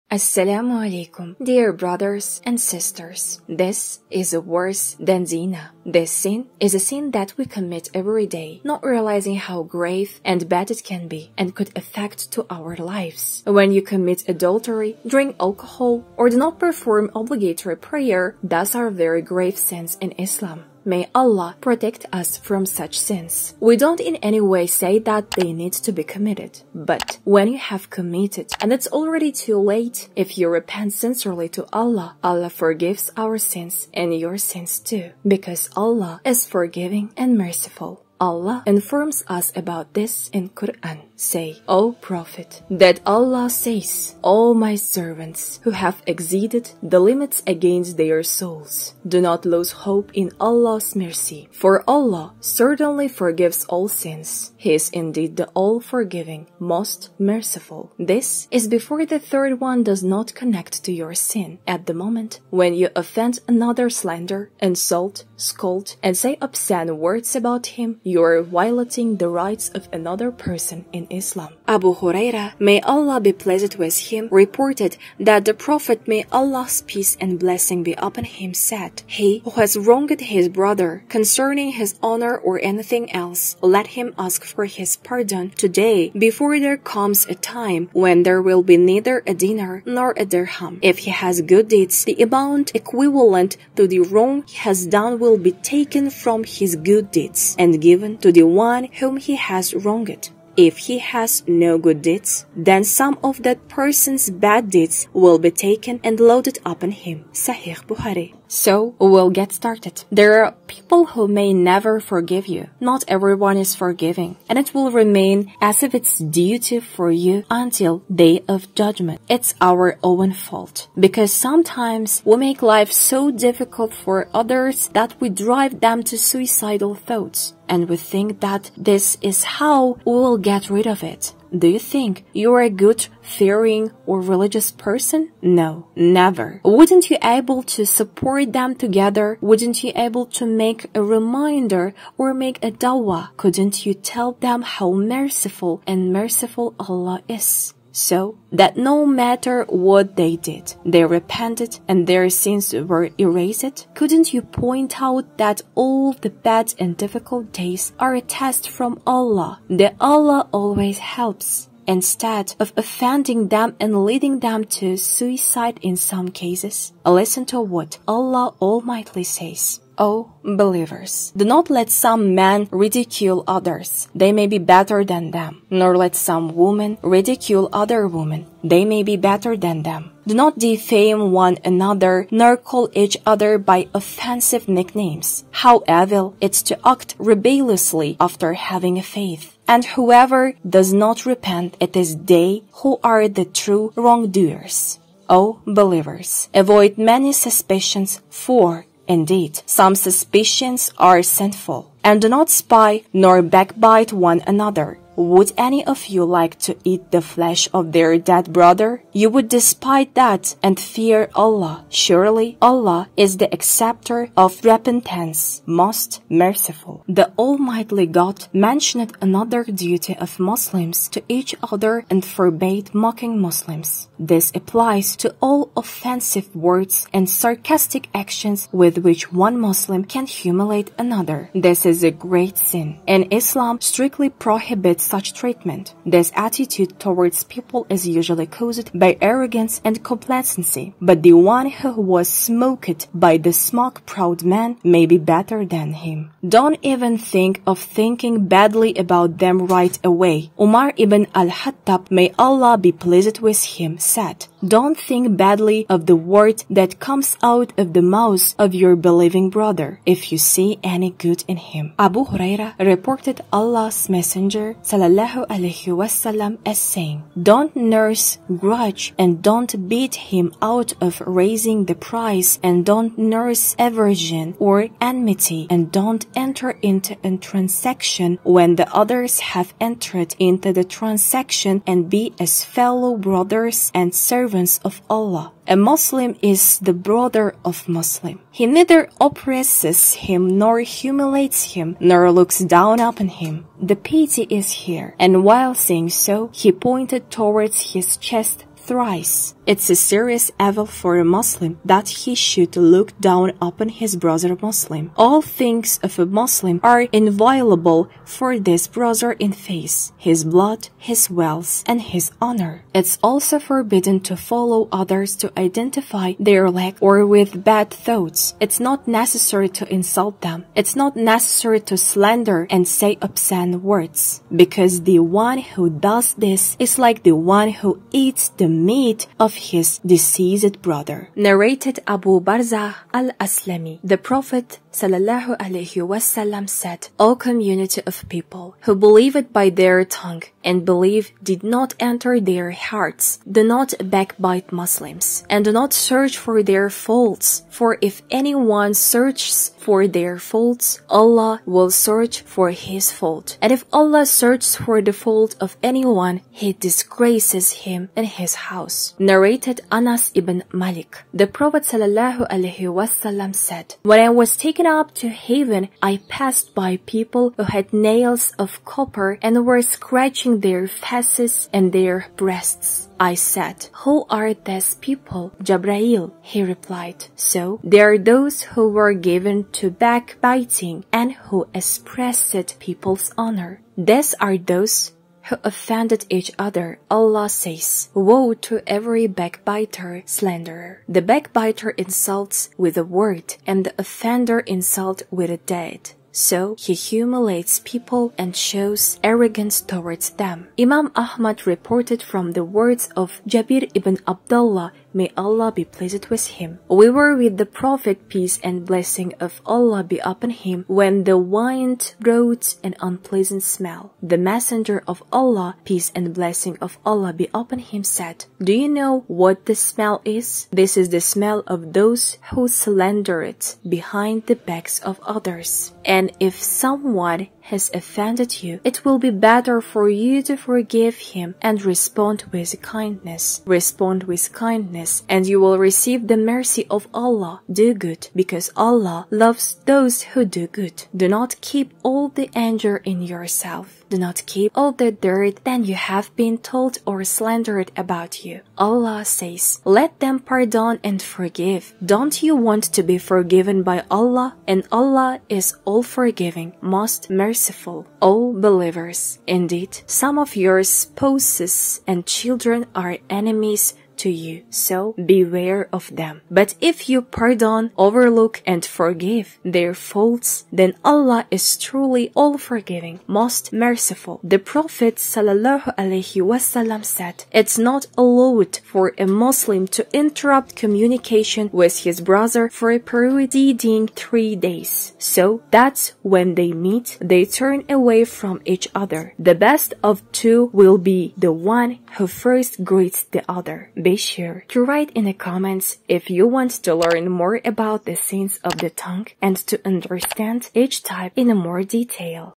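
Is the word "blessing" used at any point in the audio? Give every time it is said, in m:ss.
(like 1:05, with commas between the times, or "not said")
1:17, 6:48, 6:56.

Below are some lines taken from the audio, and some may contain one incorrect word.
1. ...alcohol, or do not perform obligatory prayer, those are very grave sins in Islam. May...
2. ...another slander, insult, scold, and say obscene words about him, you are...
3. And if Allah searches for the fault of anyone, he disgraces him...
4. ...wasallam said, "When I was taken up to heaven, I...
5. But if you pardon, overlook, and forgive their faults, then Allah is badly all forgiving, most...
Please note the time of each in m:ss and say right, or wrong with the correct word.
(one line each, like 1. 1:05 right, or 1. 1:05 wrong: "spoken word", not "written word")
1. 0:15 right
2. 1:03 right
3. 5:53 right
4. 6:02 right
5. 7:46 wrong: "truly", not "badly".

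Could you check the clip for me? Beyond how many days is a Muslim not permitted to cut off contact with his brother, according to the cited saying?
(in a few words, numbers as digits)
3.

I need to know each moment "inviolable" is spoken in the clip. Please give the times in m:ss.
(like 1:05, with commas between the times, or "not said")
5:07.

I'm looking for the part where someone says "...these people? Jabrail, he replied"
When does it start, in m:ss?
6:14.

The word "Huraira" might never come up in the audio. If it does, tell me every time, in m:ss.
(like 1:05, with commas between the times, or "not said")
1:11, 4:22.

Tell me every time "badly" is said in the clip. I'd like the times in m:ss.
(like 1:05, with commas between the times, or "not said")
4:08, 4:15.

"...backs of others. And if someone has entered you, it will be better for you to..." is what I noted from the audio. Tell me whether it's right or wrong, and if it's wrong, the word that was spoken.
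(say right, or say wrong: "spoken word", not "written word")
wrong: "offended", not "entered".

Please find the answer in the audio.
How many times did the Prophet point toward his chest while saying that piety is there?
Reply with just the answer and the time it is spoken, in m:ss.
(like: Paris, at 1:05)
3, at 4:58.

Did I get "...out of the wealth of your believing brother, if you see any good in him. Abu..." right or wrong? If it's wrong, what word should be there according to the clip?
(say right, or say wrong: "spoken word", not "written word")
wrong: "mouth", not "wealth".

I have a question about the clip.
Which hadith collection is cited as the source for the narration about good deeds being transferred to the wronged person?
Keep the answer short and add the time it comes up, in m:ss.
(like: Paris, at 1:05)
Sahih Bukhari, at 1:47.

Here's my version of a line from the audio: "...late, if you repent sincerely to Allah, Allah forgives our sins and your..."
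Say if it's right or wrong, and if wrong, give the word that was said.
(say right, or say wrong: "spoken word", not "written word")
right.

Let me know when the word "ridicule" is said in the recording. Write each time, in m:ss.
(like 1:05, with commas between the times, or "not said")
2:52, 2:57.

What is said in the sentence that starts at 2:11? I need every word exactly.
Do you think you're a good, fearing, or religious person?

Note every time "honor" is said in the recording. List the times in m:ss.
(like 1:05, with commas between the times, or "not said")
1:22, 5:12, 6:23.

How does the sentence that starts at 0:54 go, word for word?
He is indeed the all-forgiving, most merciful.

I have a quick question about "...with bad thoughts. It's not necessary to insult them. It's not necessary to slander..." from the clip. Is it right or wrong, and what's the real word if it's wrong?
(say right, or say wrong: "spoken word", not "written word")
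right.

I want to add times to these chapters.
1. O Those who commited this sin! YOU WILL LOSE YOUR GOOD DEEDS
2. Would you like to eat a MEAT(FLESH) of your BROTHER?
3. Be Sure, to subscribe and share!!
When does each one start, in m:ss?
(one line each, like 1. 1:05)
1. 1:15
2. 4:20
3. 8:10.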